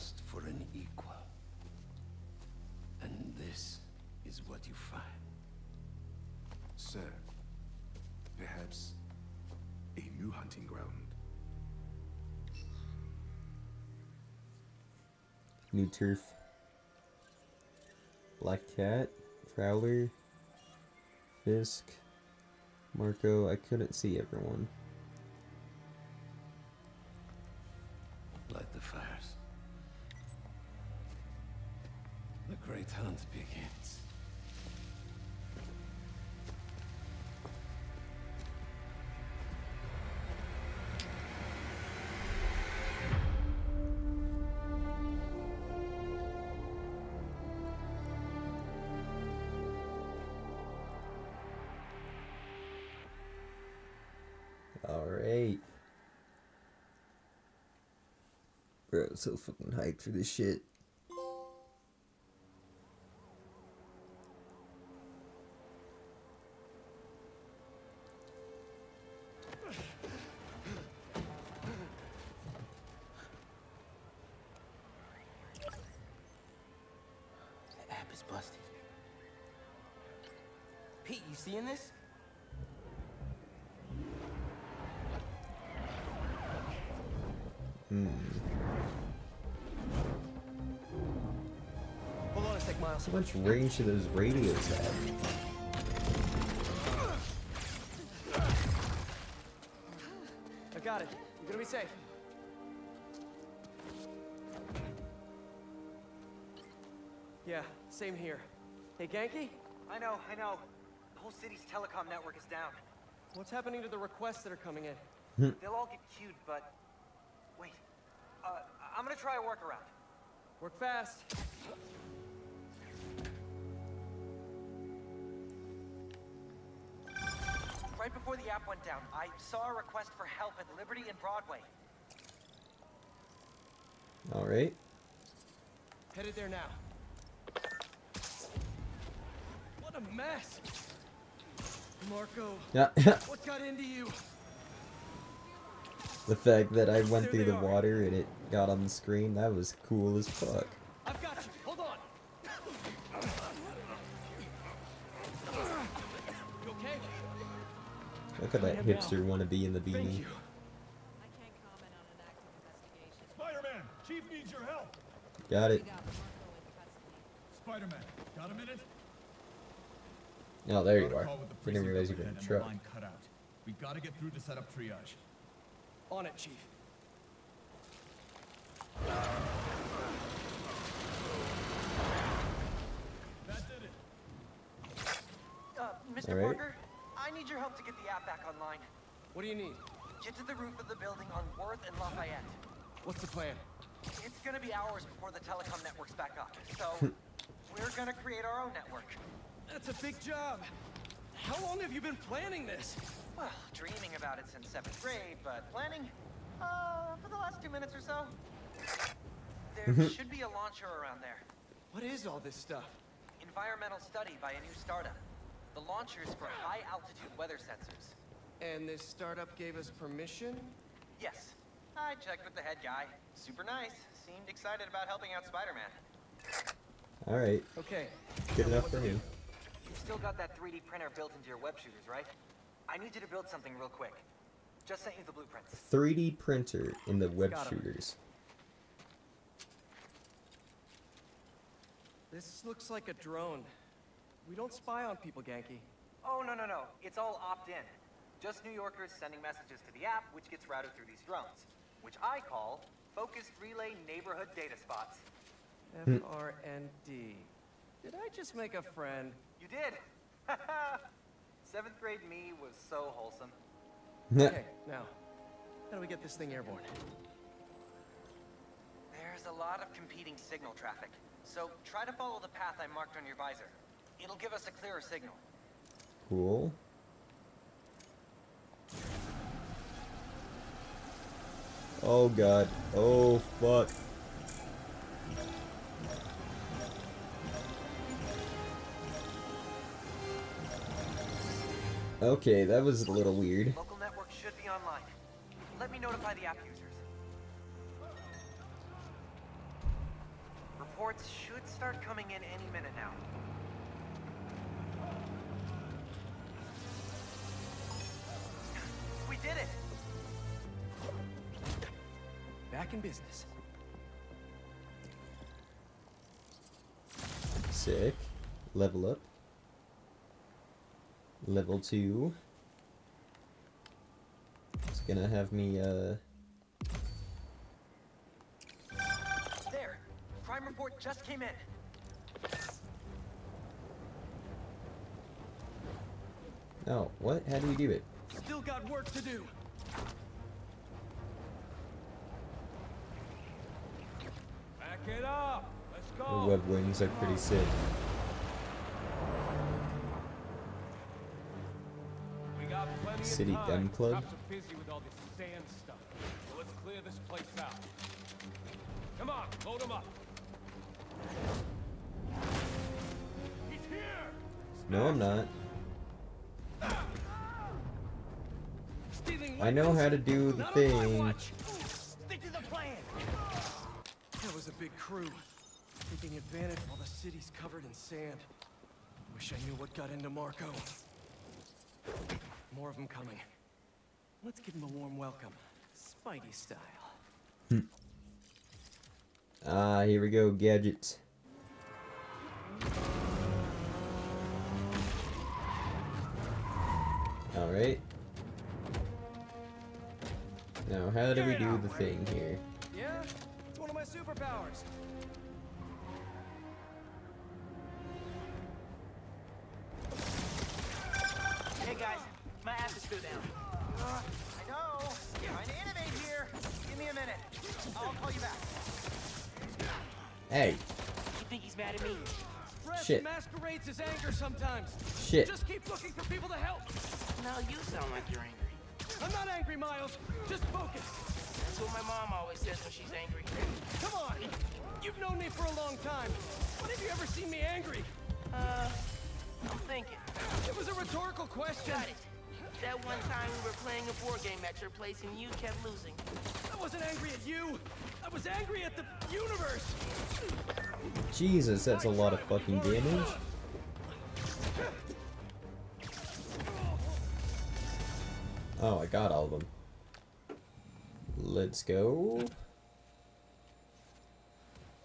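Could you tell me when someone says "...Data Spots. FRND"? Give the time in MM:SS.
04:14.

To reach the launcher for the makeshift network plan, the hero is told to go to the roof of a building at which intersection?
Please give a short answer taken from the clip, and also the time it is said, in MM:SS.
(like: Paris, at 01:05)
Worth and Lafayette, at 03:11.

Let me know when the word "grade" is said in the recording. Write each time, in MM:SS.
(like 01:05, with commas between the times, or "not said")
03:25, 04:21.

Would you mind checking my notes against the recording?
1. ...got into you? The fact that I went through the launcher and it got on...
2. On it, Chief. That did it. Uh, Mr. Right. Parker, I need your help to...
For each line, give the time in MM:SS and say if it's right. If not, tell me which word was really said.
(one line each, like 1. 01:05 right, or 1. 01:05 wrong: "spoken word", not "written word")
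1. 02:23 wrong: "water", not "launcher"
2. 02:56 right.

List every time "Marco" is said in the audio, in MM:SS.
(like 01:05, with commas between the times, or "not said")
00:22, 02:22, 06:20.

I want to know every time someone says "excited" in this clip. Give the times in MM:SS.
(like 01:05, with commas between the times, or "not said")
03:44.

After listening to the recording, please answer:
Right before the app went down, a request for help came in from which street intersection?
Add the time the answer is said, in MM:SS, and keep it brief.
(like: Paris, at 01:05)
Liberty and Broadway, at 02:10.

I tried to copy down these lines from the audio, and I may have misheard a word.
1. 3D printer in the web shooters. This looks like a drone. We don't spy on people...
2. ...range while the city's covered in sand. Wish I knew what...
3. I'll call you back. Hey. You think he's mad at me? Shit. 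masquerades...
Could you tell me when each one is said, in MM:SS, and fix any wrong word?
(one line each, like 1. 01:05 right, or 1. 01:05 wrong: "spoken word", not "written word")
1. 03:55 right
2. 06:16 wrong: "advantage", not "range"
3. 06:57 right.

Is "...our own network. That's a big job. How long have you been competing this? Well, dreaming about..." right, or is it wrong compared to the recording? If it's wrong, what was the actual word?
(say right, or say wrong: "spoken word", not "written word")
wrong: "planning", not "competing".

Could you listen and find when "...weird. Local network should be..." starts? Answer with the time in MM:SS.
04:53.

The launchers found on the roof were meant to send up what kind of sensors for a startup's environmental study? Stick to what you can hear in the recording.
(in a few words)
High-altitude weather sensors.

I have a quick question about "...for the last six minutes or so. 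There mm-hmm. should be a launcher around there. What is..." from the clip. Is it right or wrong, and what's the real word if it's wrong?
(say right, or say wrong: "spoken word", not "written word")
wrong: "two", not "six".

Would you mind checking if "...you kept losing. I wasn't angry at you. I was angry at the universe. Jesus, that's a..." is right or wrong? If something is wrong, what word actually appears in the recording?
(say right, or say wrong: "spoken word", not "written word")
right.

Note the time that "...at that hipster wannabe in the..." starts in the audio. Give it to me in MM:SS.
02:38.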